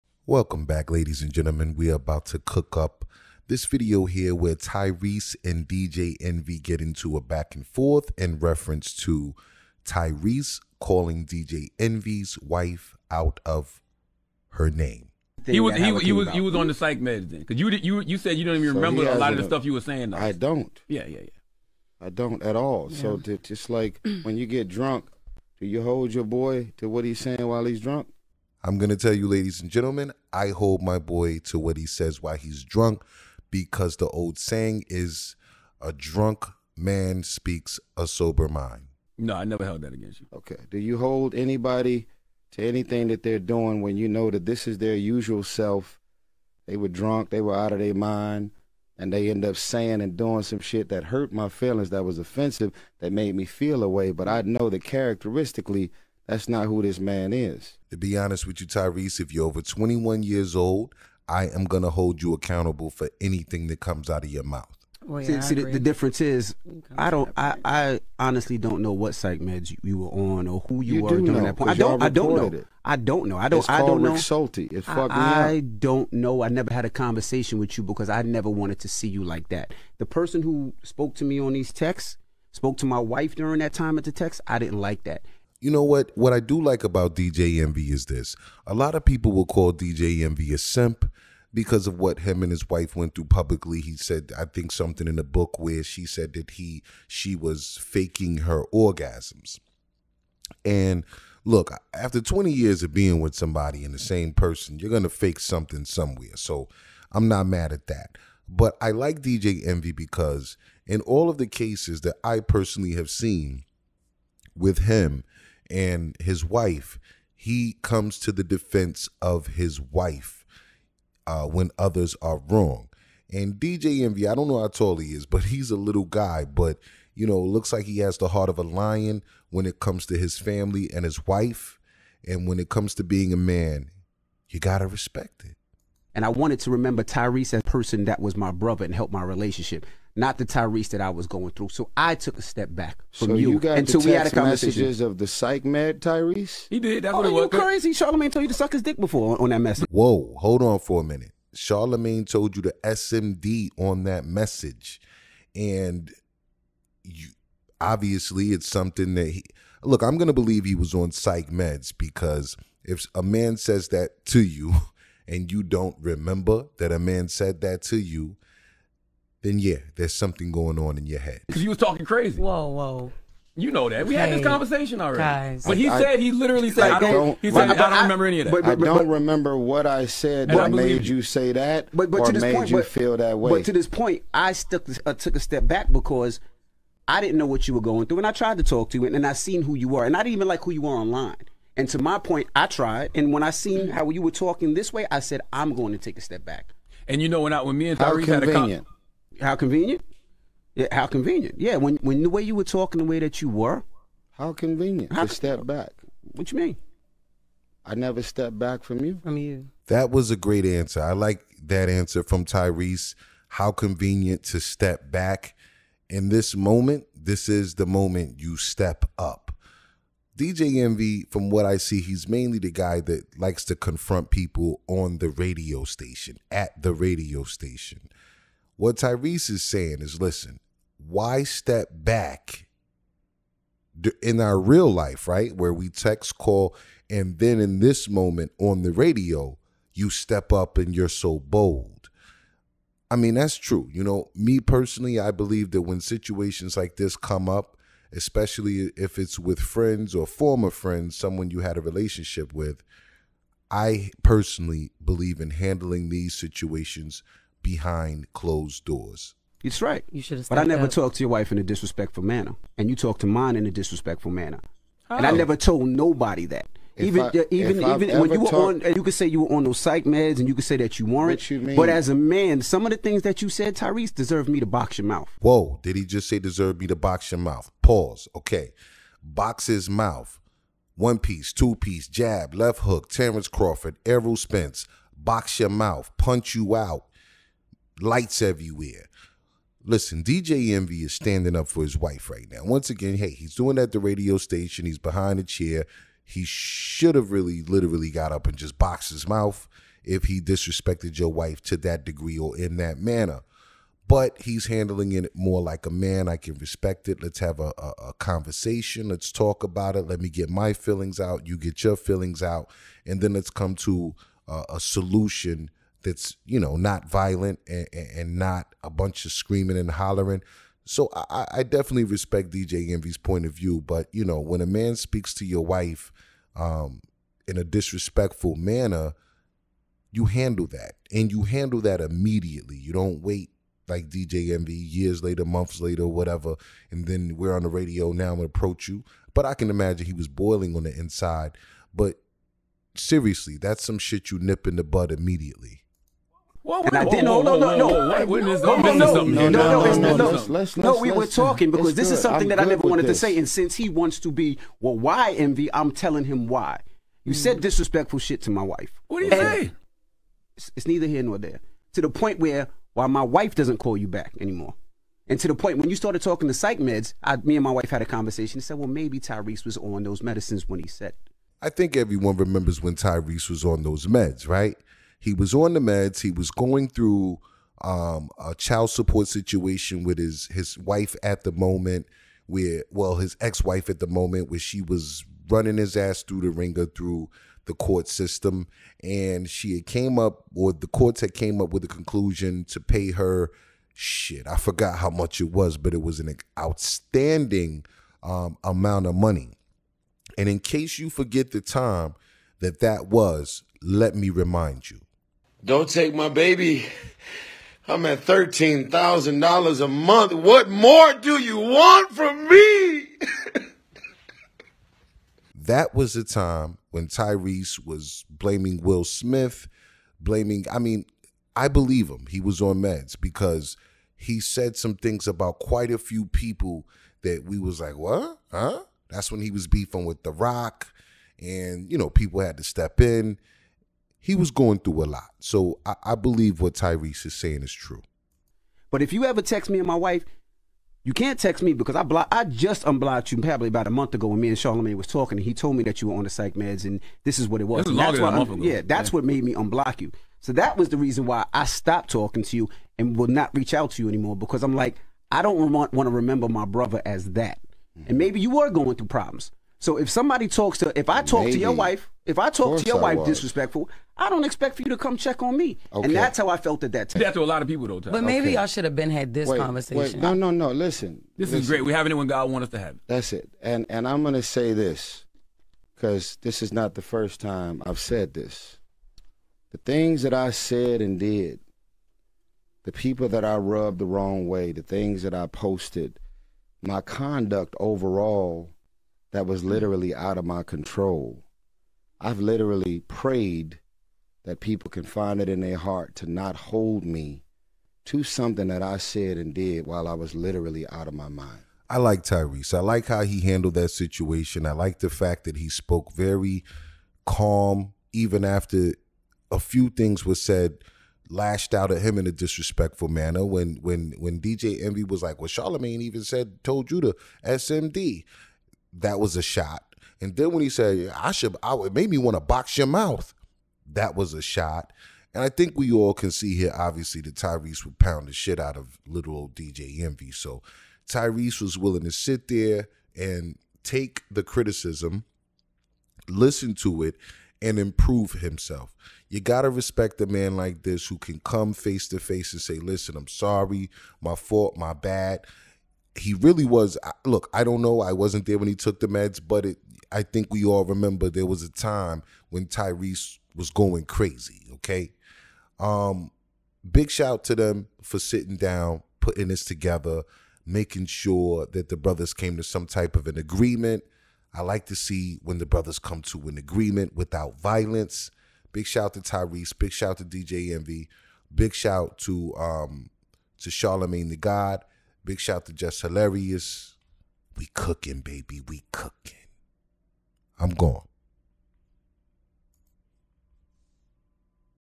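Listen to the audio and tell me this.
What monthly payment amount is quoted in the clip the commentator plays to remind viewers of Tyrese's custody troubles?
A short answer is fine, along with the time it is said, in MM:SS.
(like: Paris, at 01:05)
$13,000, at 06:48.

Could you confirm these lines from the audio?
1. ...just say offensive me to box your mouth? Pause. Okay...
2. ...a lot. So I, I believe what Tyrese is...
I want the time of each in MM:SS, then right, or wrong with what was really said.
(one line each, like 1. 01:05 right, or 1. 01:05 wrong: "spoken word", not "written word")
1. 04:36 wrong: "deserve", not "offensive"
2. 07:15 right.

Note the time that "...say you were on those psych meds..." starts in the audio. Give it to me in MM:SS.
04:29.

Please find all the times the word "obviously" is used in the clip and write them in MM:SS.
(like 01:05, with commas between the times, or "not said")
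02:37, 08:46.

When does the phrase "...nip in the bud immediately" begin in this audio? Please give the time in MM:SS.
05:44.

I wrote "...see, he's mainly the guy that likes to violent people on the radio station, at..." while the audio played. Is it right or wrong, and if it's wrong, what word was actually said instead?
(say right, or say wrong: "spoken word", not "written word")
wrong: "confront", not "violent".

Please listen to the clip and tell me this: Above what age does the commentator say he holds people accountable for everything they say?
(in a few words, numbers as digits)
over 21.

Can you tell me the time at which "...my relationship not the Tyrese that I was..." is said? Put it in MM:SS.
02:19.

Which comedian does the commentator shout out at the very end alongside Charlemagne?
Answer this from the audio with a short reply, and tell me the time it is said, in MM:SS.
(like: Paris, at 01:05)
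Jess Hilarious, at 09:35.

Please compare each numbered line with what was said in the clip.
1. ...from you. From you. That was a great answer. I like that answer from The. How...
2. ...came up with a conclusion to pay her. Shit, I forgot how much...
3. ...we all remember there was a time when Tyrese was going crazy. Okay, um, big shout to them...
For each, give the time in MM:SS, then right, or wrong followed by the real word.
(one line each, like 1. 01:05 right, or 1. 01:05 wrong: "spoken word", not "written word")
1. 03:28 wrong: "Tyrese", not "The"
2. 06:31 right
3. 09:10 right.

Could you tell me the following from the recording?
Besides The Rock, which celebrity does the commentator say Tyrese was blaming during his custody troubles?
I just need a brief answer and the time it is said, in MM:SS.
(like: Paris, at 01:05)
Will Smith, at 06:58.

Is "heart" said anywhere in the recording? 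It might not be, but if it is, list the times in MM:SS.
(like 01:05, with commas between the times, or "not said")
02:08, 08:15.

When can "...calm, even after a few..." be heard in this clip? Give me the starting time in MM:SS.
08:27.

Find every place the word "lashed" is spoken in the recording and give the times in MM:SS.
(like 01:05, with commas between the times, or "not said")
08:31.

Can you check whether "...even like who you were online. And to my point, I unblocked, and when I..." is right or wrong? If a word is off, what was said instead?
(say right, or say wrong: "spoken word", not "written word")
wrong: "tried", not "unblocked".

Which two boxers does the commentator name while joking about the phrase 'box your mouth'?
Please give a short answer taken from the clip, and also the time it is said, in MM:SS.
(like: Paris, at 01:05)
Terrence Crawford, Errol Spence, at 04:43.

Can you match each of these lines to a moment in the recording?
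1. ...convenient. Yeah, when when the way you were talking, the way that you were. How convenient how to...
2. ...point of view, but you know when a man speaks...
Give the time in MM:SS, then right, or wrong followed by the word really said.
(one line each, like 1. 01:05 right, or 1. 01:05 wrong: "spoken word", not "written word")
1. 03:21 right
2. 05:23 right.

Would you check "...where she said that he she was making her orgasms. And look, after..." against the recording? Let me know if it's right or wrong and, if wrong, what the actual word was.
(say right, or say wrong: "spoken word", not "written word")
wrong: "faking", not "making".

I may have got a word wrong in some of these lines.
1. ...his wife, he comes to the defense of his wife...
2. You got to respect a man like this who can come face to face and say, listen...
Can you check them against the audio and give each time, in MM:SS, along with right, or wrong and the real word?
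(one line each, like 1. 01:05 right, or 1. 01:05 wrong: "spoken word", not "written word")
1. 01:56 right
2. 08:59 right.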